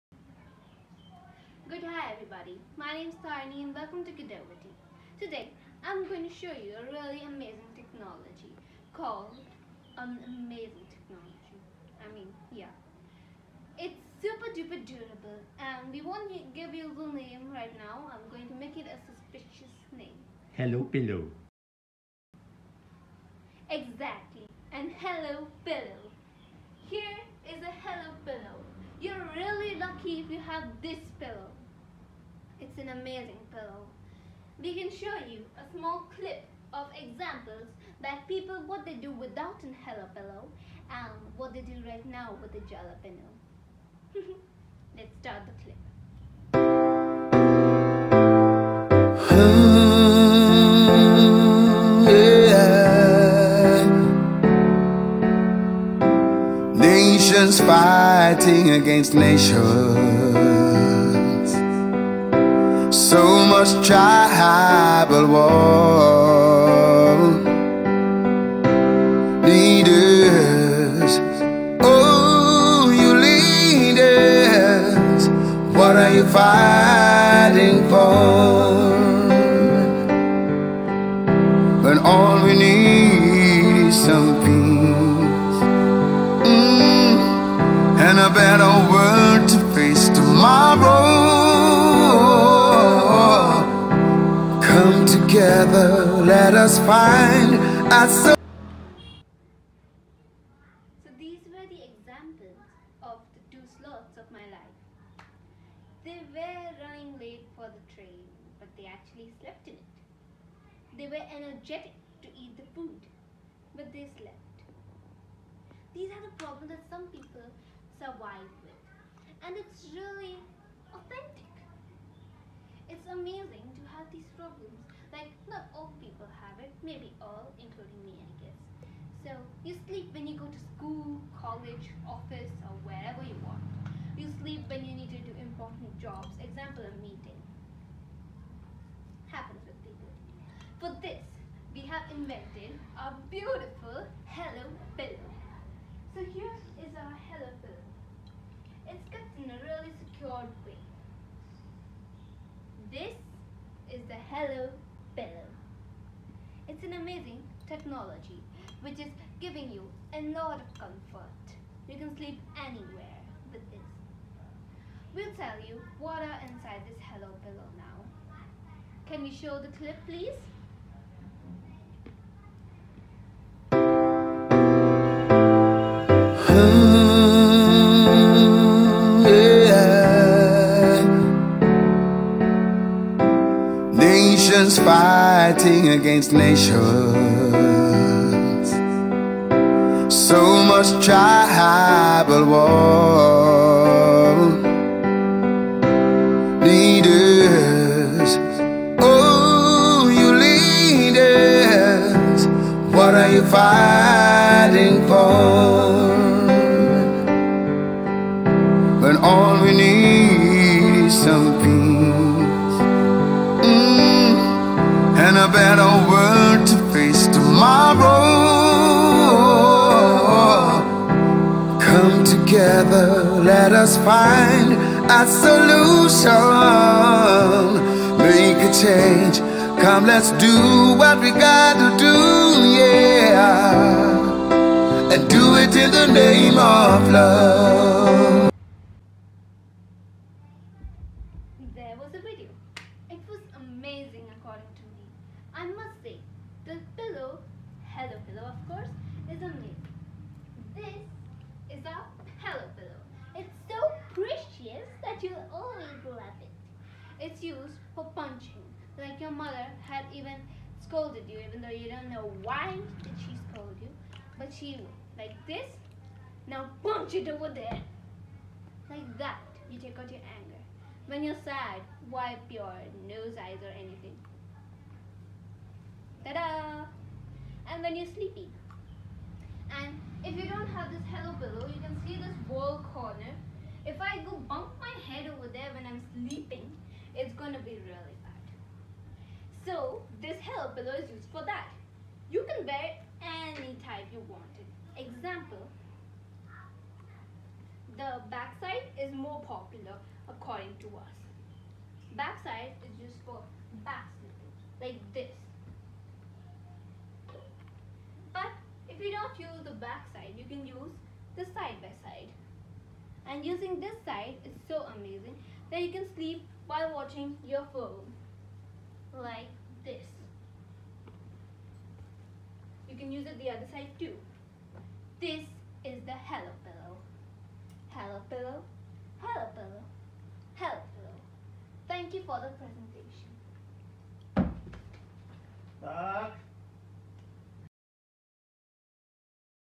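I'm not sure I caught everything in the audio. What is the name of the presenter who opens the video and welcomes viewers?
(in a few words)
Taarini.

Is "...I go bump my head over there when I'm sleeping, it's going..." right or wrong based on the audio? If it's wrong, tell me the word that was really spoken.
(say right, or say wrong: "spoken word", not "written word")
right.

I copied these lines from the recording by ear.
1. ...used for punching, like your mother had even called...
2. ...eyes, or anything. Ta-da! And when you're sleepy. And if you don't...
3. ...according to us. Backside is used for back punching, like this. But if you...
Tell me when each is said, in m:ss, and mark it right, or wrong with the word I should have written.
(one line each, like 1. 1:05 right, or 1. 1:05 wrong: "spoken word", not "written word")
1. 4:17 wrong: "scolded", not "called"
2. 4:33 right
3. 5:00 wrong: "sleeping", not "punching".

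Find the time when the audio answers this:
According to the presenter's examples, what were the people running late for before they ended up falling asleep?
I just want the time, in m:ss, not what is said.
1:47.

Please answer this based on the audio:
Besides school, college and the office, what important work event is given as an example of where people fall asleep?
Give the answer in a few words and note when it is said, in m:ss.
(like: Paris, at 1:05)
a meeting, at 2:16.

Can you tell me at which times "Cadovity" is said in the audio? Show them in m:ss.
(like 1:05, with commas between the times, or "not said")
0:04.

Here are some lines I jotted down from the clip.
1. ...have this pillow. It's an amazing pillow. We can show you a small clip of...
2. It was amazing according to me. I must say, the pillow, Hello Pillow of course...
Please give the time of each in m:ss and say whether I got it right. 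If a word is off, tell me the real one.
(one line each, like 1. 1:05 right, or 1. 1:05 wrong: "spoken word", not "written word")
1. 0:30 right
2. 4:03 right.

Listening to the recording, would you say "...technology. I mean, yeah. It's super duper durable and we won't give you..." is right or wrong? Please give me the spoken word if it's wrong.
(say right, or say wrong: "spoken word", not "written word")
right.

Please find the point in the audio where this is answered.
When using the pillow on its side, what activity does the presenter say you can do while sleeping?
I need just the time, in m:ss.
5:16.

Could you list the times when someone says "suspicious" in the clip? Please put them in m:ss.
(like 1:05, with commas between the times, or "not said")
0:19.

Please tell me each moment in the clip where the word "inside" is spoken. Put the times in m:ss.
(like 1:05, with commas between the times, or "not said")
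2:46.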